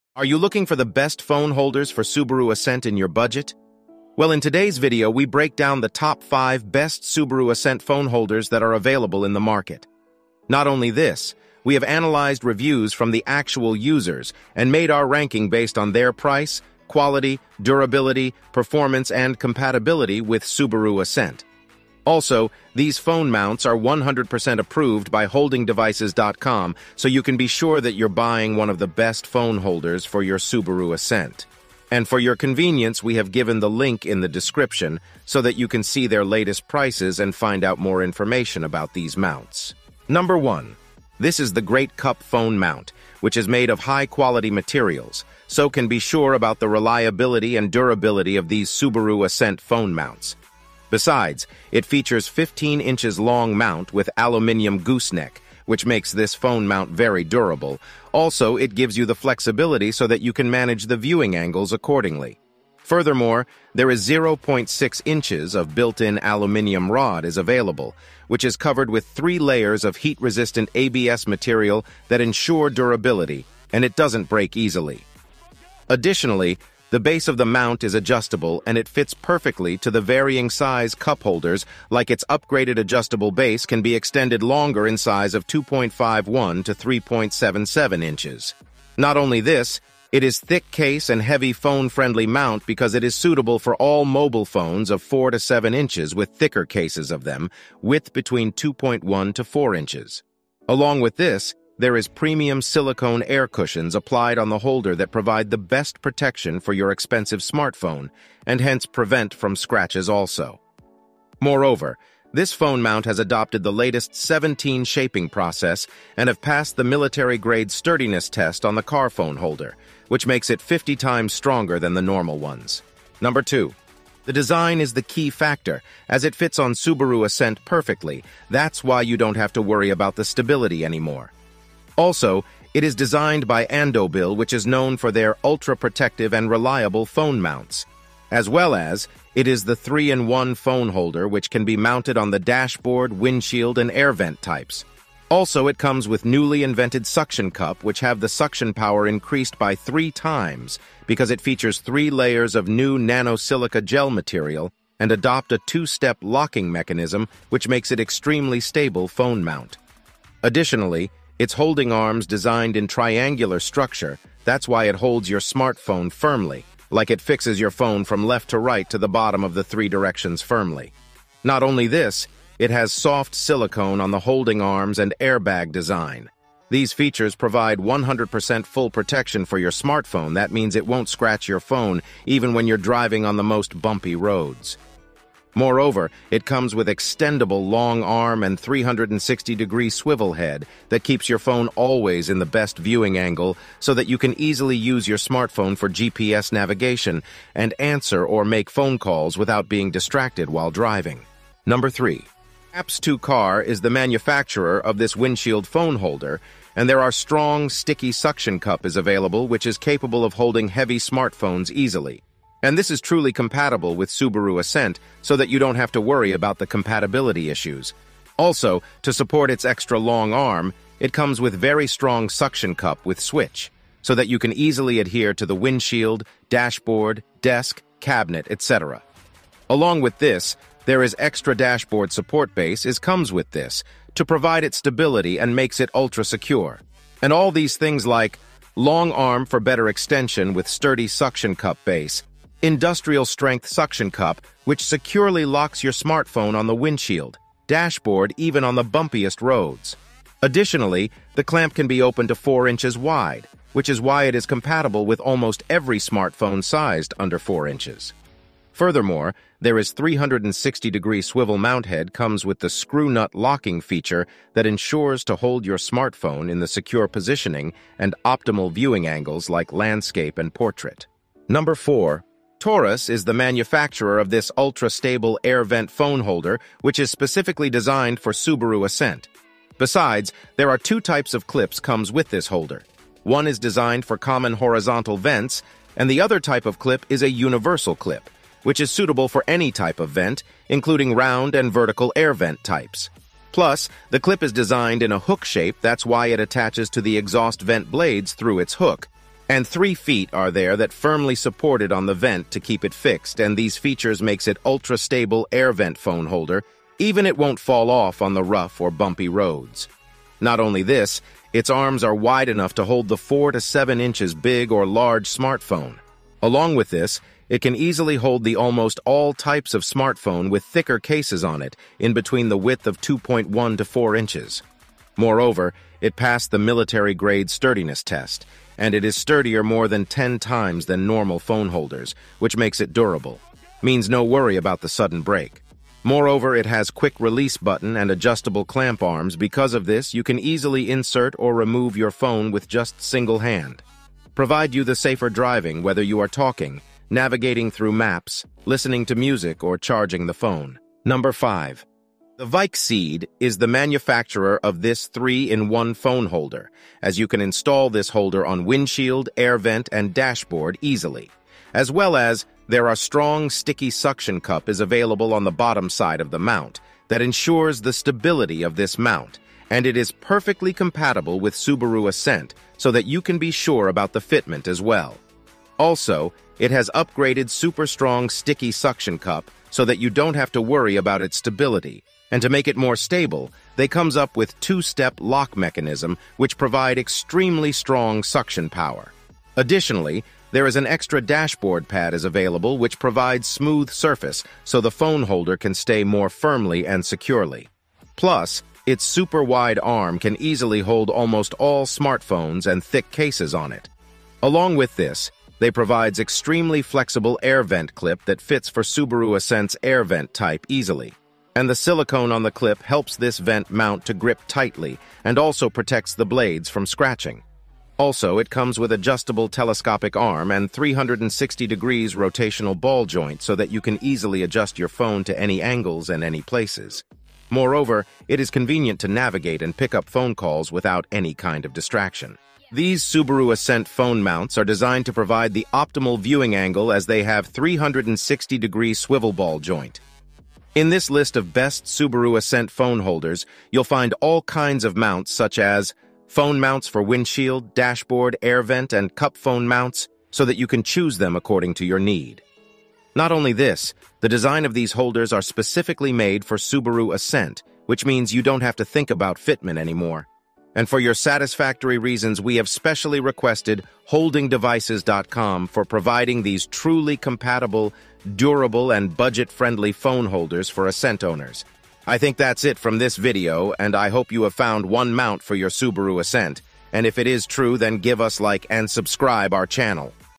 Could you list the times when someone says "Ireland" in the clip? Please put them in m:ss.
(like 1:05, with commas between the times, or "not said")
not said.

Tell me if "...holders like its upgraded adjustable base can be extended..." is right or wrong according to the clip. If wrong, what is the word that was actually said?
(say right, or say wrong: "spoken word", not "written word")
right.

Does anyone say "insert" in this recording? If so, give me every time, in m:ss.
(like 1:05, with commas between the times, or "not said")
5:40.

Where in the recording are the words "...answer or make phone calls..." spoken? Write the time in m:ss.
3:17.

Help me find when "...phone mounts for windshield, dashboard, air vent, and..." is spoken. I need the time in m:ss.
7:26.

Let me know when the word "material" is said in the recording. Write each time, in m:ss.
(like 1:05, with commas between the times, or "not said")
0:44, 1:11, 2:34.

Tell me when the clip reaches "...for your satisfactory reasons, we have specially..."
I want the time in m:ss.
7:40.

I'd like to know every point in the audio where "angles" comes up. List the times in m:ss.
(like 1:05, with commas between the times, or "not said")
1:01, 3:13, 4:29, 7:05, 7:16.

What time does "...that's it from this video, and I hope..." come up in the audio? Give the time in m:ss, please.
7:52.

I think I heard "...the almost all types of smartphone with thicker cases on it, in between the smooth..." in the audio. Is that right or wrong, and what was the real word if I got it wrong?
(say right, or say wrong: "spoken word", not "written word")
wrong: "width", not "smooth".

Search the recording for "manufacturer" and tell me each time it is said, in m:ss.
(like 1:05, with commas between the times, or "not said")
3:23, 4:33, 5:53.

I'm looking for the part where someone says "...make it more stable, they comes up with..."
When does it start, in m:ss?
6:22.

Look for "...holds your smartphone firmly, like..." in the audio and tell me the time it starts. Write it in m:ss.
2:44.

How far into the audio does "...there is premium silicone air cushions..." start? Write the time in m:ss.
1:41.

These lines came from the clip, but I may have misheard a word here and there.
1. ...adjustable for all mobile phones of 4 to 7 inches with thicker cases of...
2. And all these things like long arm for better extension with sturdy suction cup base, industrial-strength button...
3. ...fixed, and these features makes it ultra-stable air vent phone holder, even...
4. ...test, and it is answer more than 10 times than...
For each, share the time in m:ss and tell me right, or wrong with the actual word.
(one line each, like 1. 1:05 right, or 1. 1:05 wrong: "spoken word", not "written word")
1. 1:33 wrong: "suitable", not "adjustable"
2. 3:57 wrong: "suction", not "button"
3. 5:02 right
4. 5:28 wrong: "sturdier", not "answer".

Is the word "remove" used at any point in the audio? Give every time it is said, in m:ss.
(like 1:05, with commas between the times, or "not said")
5:41.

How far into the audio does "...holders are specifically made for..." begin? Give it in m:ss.
7:34.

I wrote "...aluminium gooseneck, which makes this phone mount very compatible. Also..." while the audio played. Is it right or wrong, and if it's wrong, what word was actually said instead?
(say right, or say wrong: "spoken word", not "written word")
wrong: "durable", not "compatible".